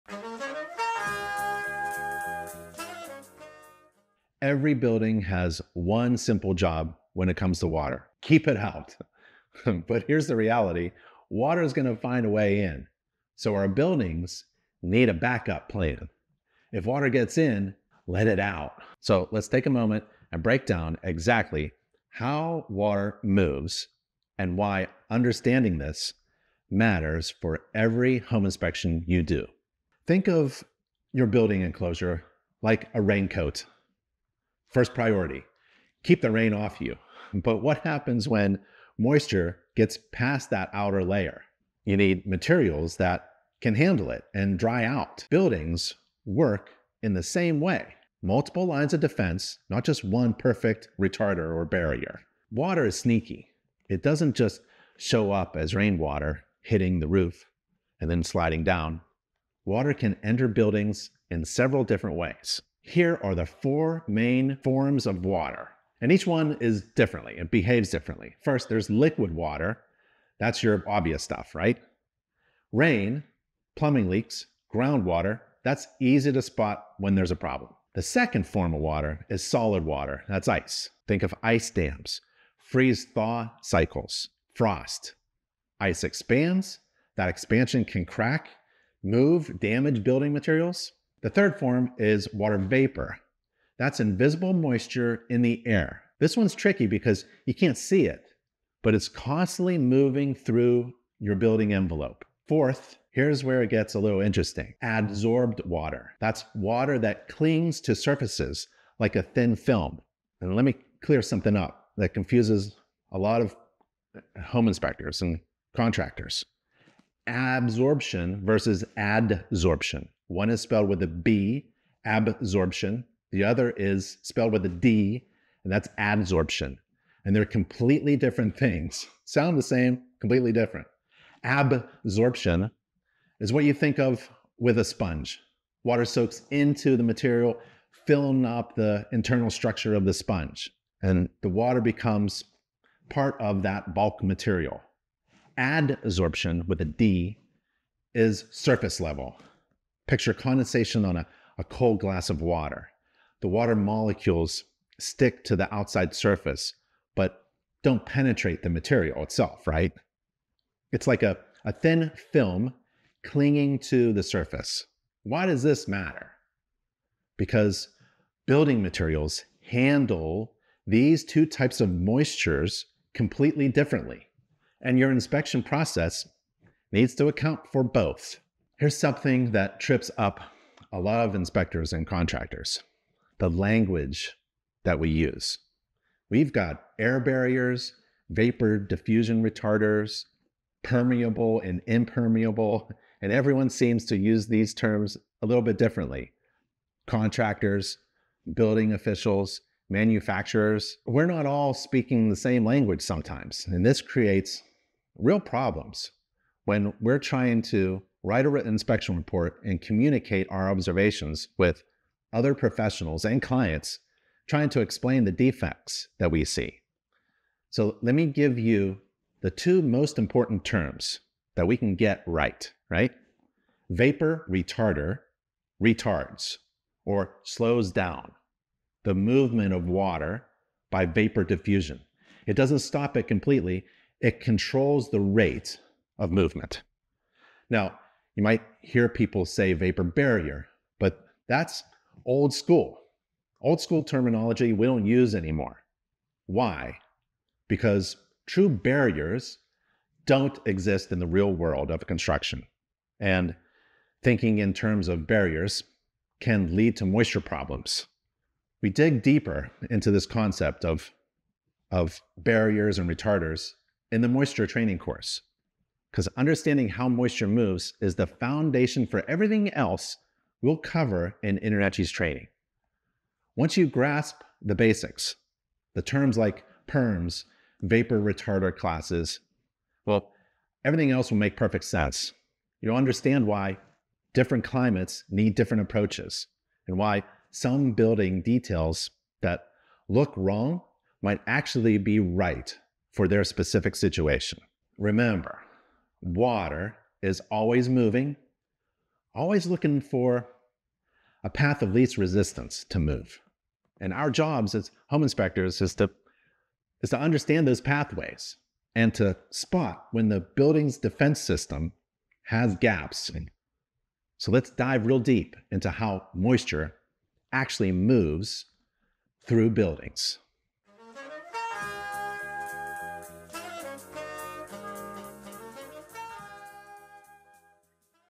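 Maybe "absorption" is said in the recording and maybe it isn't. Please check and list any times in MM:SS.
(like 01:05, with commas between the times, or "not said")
01:57, 02:02, 02:11.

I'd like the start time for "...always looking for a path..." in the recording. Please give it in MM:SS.
04:59.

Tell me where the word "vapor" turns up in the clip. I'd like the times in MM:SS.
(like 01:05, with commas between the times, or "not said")
01:32, 03:08, 03:43, 03:51, 03:59, 04:37.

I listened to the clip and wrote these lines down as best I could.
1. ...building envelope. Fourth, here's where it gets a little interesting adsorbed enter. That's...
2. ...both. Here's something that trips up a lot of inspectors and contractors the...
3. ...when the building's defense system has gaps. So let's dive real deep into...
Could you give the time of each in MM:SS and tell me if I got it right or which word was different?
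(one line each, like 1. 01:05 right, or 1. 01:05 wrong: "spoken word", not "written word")
1. 01:41 wrong: "water", not "enter"
2. 02:57 right
3. 05:10 right.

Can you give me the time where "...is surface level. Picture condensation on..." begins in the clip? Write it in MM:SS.
02:28.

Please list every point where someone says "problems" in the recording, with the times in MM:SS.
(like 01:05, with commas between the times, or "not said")
01:17, 03:25, 04:17.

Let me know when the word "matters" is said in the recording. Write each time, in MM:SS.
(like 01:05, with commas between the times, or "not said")
00:26, 02:45.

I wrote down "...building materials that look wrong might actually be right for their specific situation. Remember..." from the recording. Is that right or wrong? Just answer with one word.
wrong.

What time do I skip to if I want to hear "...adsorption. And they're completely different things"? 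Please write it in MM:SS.
02:05.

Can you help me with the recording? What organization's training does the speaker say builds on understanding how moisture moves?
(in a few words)
InterNACHI.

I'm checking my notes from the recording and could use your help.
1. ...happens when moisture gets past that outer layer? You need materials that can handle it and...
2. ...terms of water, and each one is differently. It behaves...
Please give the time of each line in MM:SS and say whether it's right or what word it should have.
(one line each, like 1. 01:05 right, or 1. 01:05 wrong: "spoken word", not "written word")
1. 00:37 right
2. 01:04 wrong: "forms", not "terms".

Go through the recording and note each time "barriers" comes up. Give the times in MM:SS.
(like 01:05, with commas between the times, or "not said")
00:51, 03:07, 04:00, 04:08, 04:15, 04:22.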